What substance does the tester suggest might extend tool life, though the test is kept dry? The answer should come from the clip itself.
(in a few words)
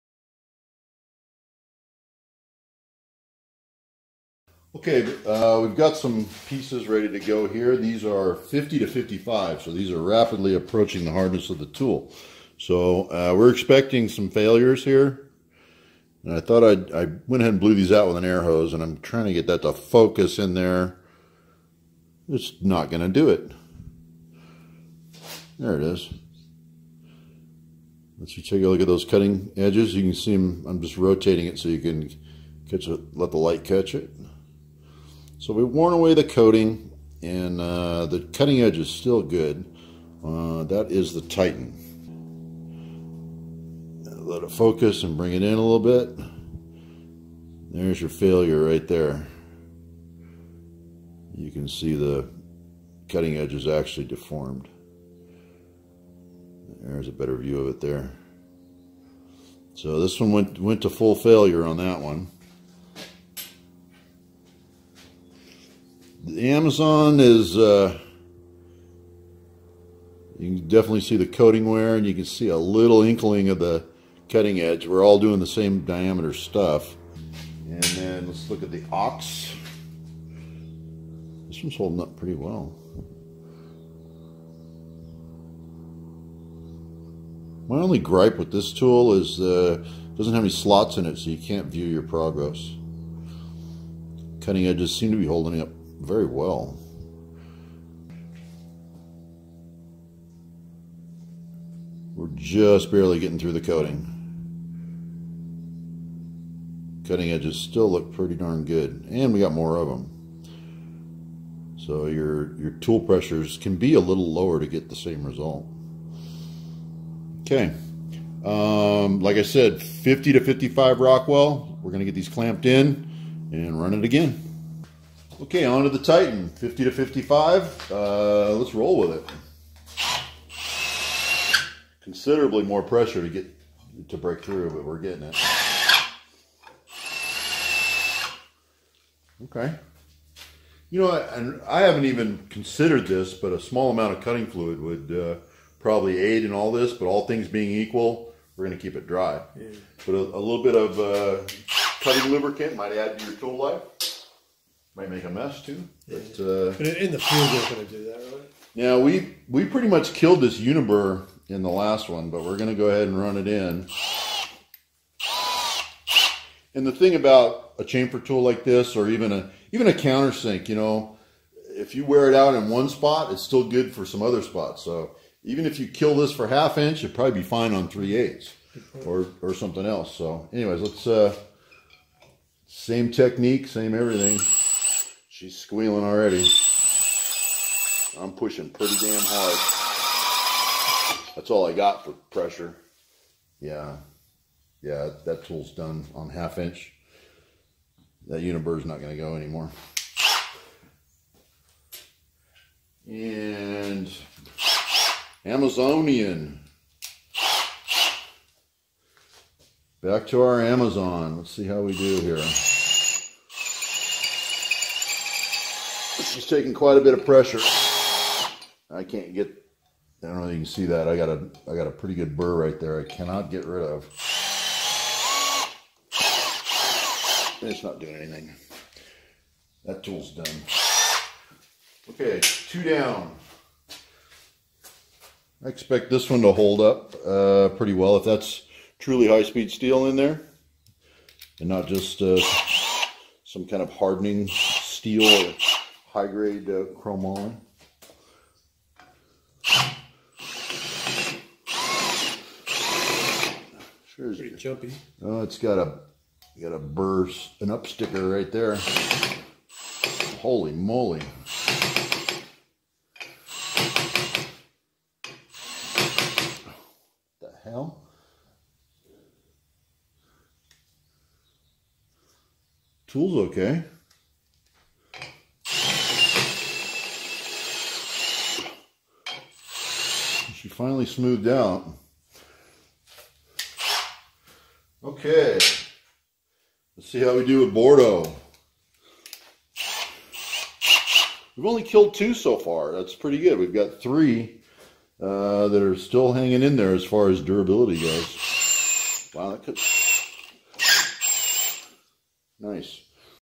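cutting fluid.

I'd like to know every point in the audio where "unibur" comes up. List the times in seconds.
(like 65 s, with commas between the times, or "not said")
160 s, 198 s.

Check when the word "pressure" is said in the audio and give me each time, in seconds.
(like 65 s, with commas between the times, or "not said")
113 s, 132 s, 192 s, 217 s.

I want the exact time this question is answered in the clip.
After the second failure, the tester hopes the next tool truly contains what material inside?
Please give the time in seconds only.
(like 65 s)
239 s.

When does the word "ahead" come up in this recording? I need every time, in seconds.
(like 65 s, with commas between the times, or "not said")
17 s, 162 s.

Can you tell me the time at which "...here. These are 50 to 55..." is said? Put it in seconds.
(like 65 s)
7 s.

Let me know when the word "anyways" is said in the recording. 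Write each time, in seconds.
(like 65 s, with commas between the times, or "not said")
180 s.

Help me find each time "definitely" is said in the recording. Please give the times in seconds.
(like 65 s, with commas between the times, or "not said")
70 s.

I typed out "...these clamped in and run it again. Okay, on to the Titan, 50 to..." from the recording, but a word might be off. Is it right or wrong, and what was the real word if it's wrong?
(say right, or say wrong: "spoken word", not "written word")
right.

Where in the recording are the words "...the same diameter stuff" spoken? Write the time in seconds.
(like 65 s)
75 s.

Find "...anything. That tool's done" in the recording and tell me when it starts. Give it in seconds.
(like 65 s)
228 s.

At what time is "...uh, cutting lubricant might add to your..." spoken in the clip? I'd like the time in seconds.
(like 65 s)
150 s.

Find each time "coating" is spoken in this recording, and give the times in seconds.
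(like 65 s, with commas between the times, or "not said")
36 s, 71 s, 103 s.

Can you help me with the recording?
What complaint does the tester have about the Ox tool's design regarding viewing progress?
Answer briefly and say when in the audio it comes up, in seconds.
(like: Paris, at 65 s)
doesn't have any slots, at 90 s.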